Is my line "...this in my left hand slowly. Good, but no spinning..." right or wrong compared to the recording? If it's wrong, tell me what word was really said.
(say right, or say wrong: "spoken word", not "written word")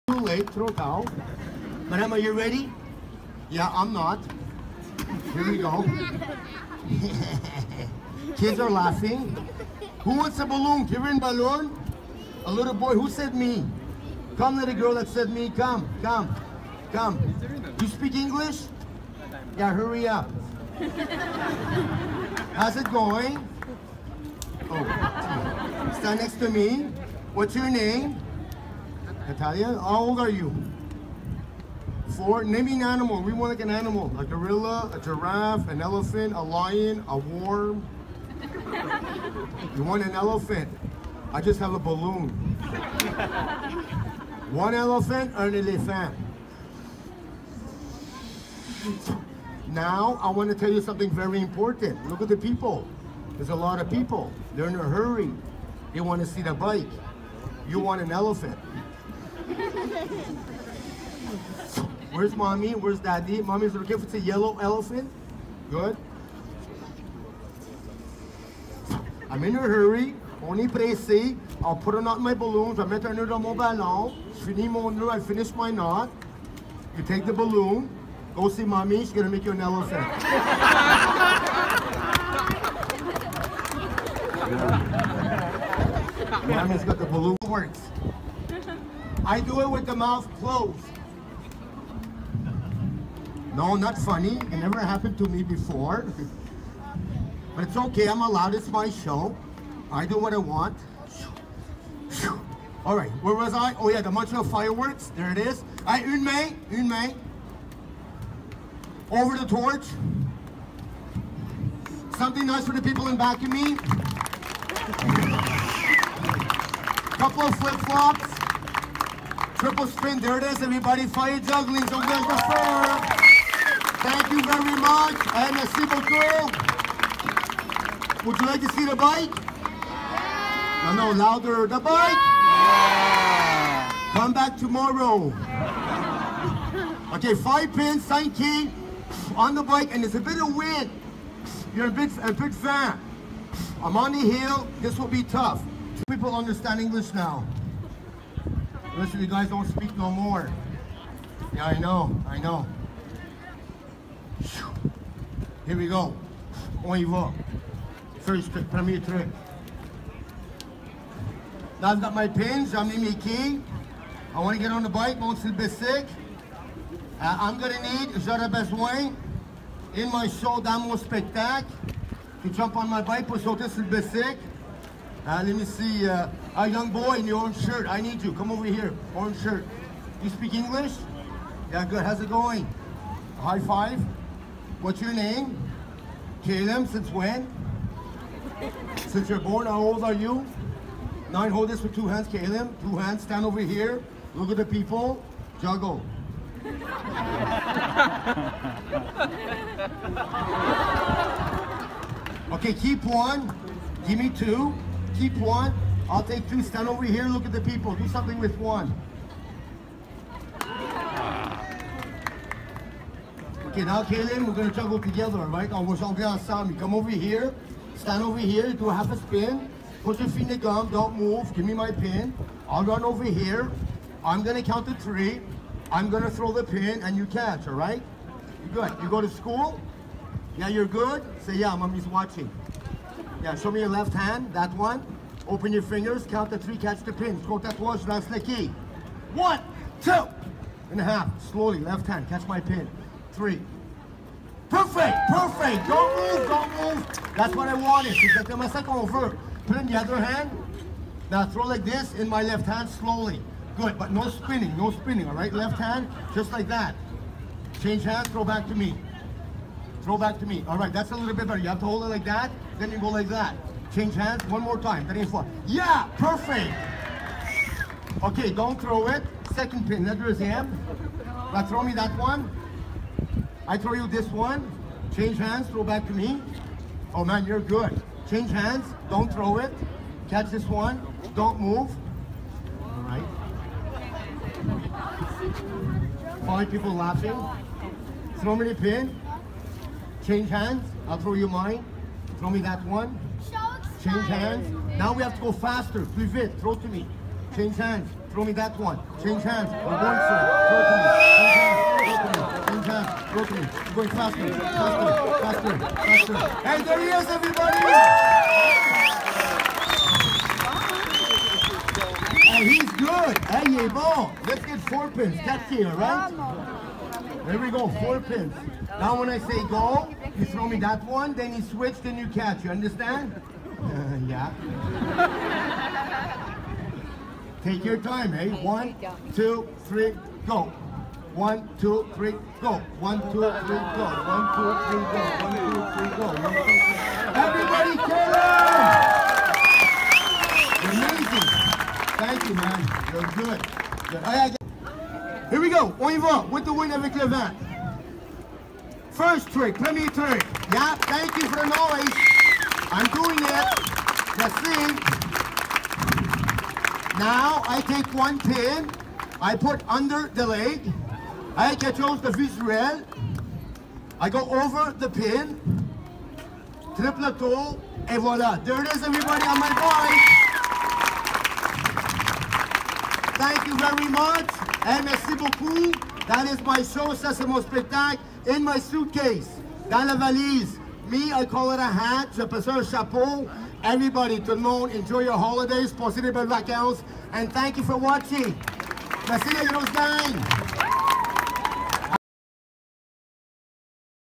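right.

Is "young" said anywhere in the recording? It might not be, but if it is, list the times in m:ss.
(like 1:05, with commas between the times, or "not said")
2:56.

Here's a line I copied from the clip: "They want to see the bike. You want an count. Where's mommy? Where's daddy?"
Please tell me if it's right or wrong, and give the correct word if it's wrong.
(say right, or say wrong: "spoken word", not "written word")
wrong: "elephant", not "count".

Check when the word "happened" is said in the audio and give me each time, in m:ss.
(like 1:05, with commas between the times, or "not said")
1:34.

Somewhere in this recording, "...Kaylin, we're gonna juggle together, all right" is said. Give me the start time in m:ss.
3:34.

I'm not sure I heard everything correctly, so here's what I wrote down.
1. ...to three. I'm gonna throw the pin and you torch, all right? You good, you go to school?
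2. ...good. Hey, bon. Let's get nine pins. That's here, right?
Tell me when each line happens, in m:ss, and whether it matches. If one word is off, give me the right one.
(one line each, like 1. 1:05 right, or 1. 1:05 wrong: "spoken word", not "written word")
1. 3:44 wrong: "catch", not "torch"
2. 5:12 wrong: "four", not "nine".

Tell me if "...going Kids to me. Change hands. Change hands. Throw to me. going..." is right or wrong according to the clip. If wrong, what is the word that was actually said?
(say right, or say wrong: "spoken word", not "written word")
wrong: "Throw", not "Kids".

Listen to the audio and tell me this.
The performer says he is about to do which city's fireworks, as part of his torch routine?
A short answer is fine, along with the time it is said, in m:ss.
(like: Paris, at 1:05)
Montreal, at 1:44.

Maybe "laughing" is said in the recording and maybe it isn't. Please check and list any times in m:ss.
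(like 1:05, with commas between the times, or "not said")
0:08, 4:46.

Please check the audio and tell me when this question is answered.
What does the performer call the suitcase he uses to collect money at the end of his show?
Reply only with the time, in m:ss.
6:21.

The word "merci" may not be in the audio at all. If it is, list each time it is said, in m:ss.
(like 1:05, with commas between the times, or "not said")
6:15, 6:29.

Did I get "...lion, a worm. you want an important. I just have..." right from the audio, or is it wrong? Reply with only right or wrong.
wrong.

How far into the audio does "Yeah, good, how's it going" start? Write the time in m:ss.
3:01.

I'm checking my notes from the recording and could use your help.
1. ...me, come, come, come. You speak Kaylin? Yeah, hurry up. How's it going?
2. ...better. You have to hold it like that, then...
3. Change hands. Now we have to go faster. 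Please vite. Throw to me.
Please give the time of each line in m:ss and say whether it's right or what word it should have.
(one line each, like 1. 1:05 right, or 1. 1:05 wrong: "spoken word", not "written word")
1. 0:15 wrong: "English", not "Kaylin"
2. 4:21 right
3. 4:54 right.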